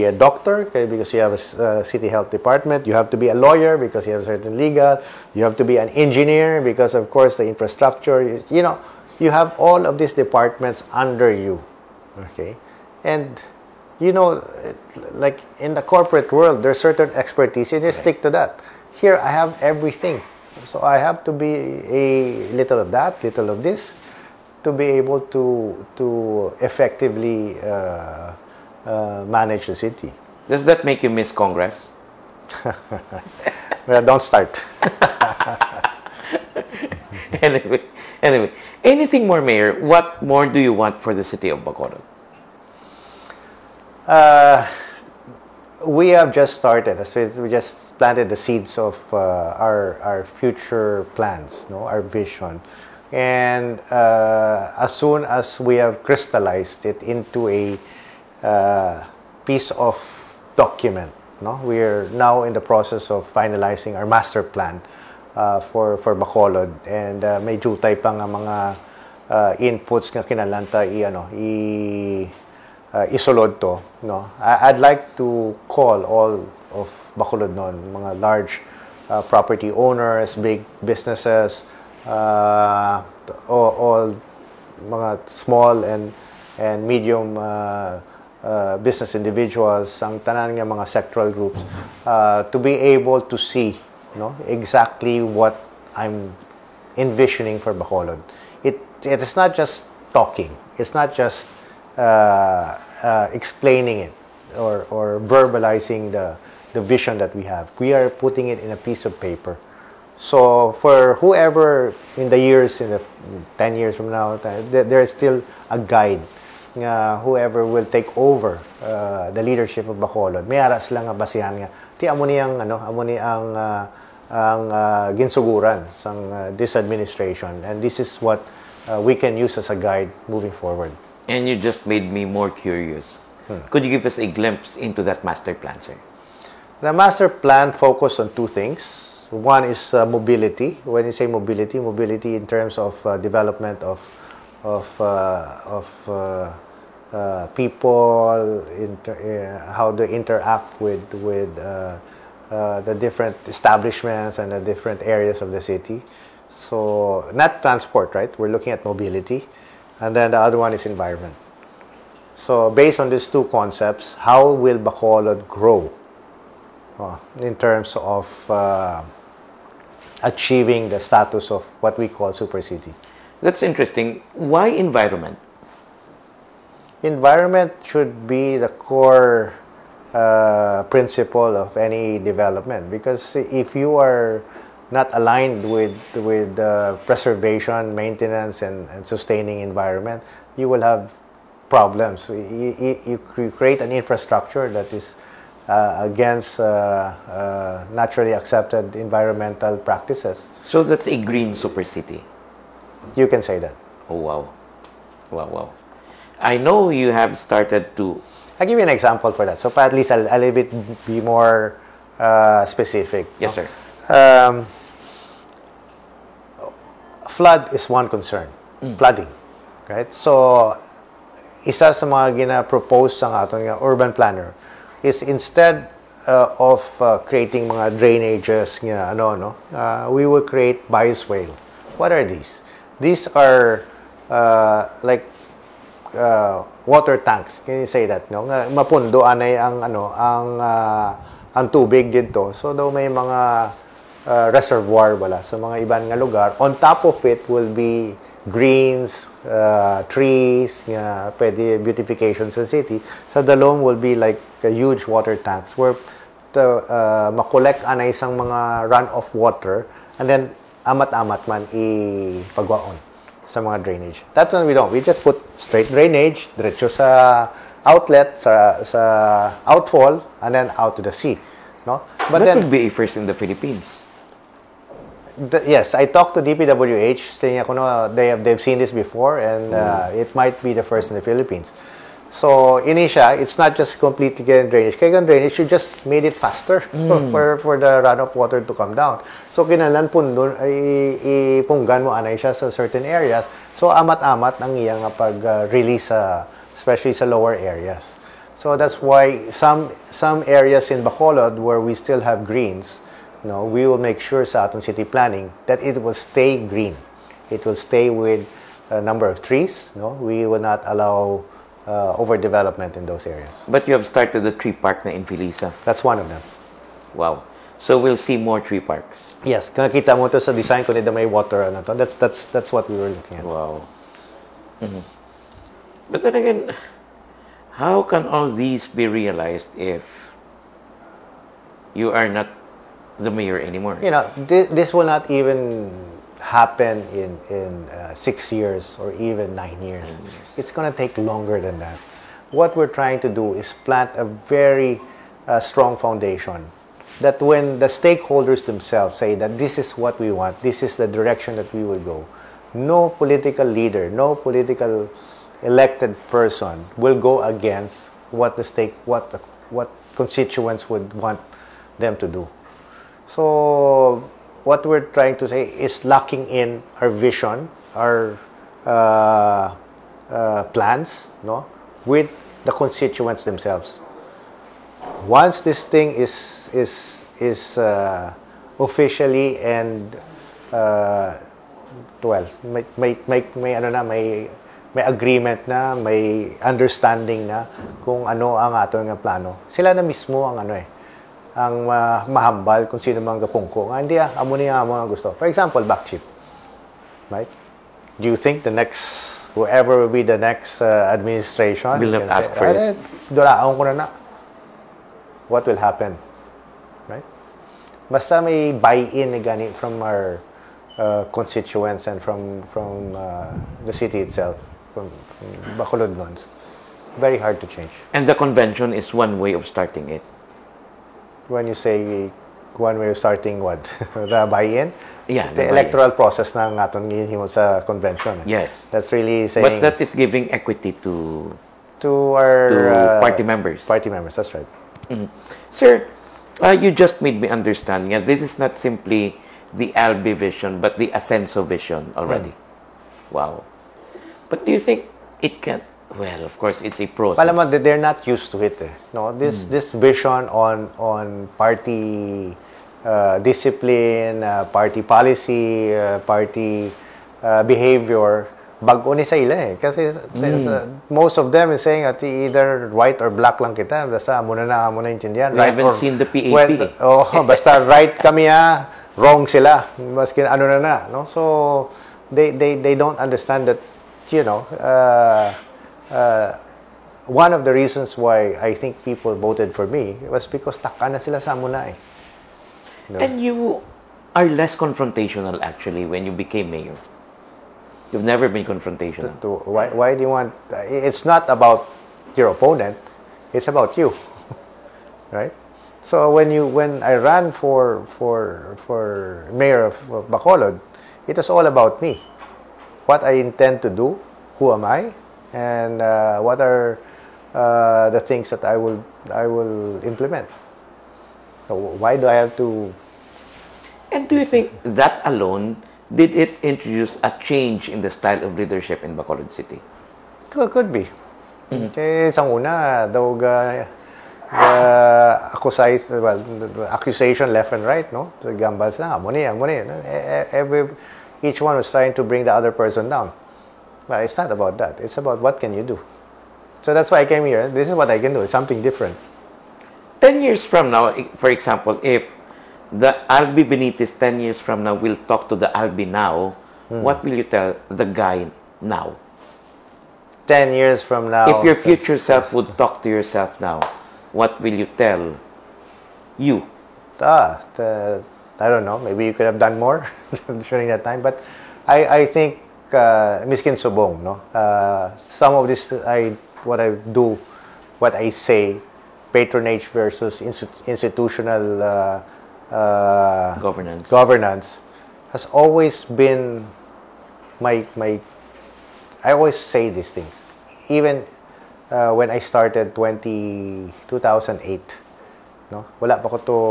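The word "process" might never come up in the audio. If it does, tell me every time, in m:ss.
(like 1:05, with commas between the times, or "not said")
1:02, 7:06, 7:27.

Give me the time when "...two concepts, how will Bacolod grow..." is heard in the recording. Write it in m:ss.
2:43.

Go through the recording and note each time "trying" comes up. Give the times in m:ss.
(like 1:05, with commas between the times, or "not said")
5:42, 6:05, 8:51.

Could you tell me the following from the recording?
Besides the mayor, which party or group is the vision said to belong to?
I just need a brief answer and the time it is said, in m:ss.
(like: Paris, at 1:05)
Ascenso, at 7:21.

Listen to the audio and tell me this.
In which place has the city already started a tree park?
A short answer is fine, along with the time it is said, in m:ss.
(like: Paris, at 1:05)
Felisa, at 5:15.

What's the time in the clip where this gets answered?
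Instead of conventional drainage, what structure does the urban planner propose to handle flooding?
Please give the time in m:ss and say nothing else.
3:50.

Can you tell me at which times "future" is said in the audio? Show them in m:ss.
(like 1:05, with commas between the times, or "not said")
0:50, 9:11.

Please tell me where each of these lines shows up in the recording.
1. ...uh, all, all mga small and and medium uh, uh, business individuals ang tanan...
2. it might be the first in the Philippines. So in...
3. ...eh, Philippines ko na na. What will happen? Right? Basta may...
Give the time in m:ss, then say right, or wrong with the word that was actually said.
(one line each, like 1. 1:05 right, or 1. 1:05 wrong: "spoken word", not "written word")
1. 1:22 right
2. 4:40 right
3. 6:42 wrong: "Dulaon", not "Philippines".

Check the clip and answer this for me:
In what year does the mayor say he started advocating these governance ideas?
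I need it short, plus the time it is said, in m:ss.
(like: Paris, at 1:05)
2008, at 9:44.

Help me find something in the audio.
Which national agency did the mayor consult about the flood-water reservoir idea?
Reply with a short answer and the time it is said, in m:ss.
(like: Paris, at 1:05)
DPWH, at 4:36.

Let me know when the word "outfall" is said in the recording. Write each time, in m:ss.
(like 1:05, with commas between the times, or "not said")
4:29.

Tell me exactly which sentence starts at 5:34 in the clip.
You know, th this will not even happen in in uh, six years or even nine years.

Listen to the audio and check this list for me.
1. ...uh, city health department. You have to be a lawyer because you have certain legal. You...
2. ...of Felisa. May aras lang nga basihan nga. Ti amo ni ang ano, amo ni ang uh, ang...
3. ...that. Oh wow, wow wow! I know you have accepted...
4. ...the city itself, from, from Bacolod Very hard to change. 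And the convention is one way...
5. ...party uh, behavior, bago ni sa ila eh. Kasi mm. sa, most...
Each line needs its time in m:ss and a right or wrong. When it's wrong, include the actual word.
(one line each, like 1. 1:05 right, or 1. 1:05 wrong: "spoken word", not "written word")
1. 0:01 right
2. 1:59 wrong: "Bacolod", not "Felisa"
3. 3:23 wrong: "started", not "accepted"
4. 6:53 right
5. 7:36 right.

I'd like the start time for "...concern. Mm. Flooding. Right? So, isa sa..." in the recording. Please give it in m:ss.
3:38.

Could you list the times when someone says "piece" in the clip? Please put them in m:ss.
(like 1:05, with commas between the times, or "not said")
0:59, 1:48.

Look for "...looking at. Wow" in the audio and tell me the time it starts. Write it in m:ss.
5:23.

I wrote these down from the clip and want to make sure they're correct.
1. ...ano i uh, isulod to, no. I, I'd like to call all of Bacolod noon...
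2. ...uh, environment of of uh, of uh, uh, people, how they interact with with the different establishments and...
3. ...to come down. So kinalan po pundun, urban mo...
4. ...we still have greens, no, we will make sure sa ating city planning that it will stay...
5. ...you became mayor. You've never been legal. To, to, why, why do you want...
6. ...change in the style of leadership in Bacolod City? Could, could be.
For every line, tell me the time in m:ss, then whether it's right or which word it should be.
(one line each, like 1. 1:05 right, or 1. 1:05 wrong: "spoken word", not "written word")
1. 1:11 right
2. 2:23 wrong: "development", not "environment"
3. 4:48 wrong: "ipunggan", not "urban"
4. 5:01 right
5. 8:06 wrong: "confrontational", not "legal"
6. 8:37 right.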